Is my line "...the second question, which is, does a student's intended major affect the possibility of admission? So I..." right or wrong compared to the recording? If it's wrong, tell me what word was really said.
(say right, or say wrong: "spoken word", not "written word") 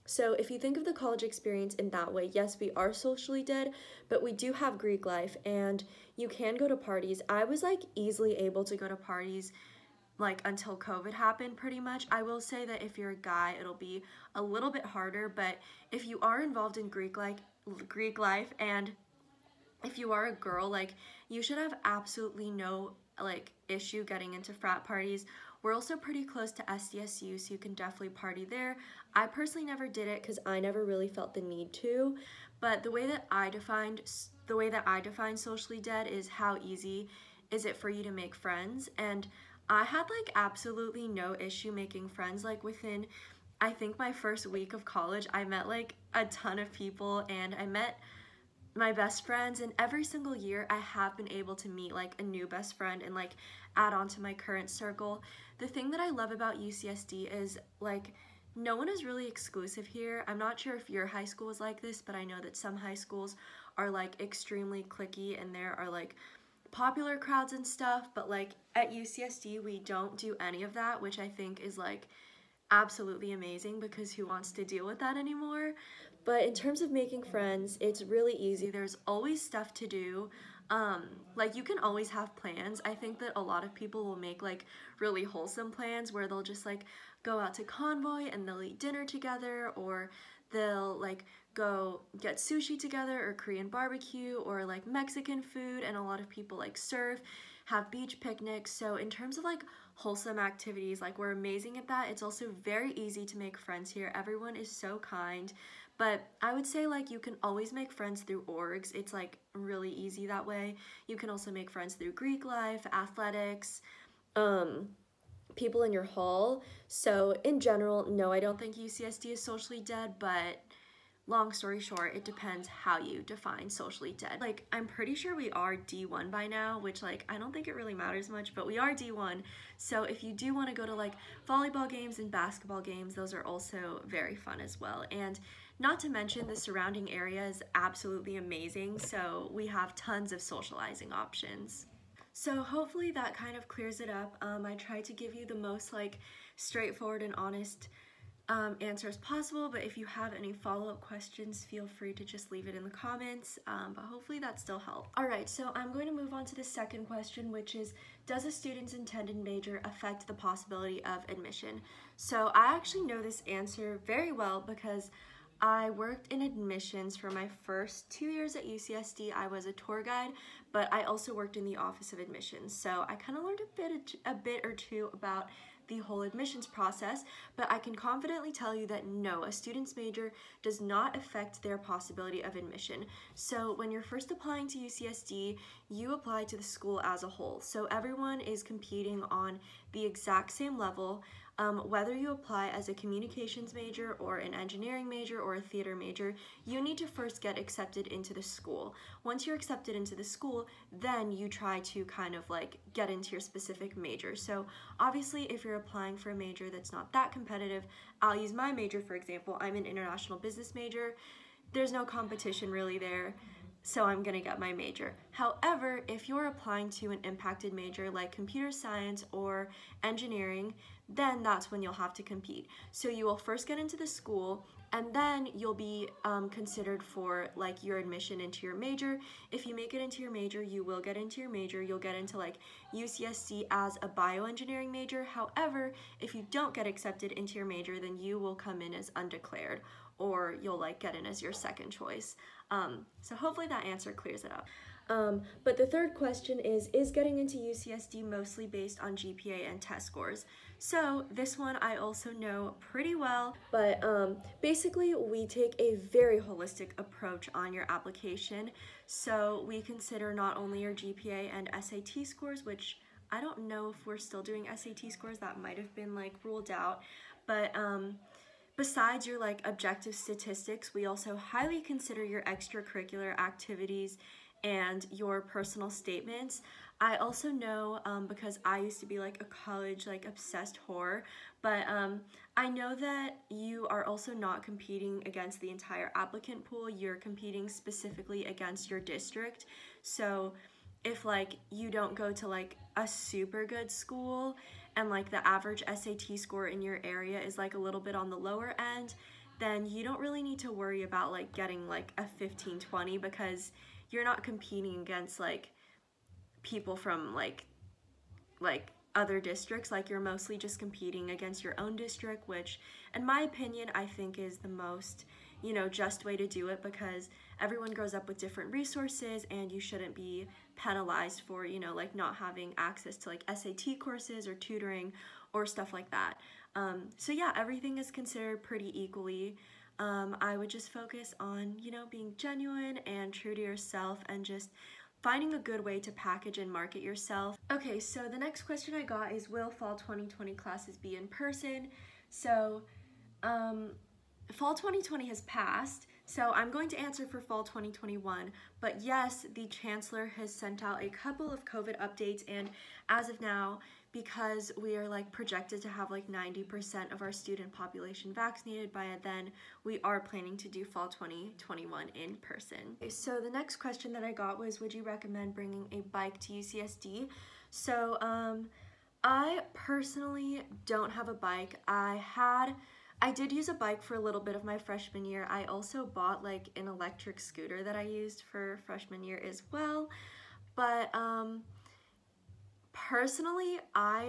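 right.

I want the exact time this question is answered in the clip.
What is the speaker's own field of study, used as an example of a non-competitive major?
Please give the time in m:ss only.
3:29.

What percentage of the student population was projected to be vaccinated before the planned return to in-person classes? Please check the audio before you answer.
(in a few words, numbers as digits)
90%.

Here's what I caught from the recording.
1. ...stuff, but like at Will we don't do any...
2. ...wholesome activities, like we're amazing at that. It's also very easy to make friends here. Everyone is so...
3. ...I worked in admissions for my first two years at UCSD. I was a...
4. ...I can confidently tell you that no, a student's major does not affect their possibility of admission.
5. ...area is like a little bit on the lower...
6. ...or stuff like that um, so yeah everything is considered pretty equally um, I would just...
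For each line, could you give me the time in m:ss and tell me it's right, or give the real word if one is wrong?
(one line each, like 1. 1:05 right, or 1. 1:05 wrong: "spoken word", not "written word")
1. 1:07 wrong: "UCSD", not "Will"
2. 1:39 right
3. 2:45 right
4. 2:57 right
5. 4:57 right
6. 5:25 right.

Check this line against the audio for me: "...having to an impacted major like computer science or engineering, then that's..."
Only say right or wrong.
wrong.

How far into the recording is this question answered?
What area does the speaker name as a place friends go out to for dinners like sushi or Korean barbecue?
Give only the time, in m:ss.
1:27.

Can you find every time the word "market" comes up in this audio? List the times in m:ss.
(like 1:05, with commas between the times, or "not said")
5:36.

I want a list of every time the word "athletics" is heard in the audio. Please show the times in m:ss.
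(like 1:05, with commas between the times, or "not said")
1:52.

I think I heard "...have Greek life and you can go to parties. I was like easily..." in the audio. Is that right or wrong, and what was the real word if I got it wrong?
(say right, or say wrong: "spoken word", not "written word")
right.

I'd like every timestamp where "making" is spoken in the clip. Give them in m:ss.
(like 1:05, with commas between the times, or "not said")
0:41, 1:16.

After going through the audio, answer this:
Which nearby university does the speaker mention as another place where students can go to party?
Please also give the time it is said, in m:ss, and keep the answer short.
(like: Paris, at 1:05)
SDSU, at 0:26.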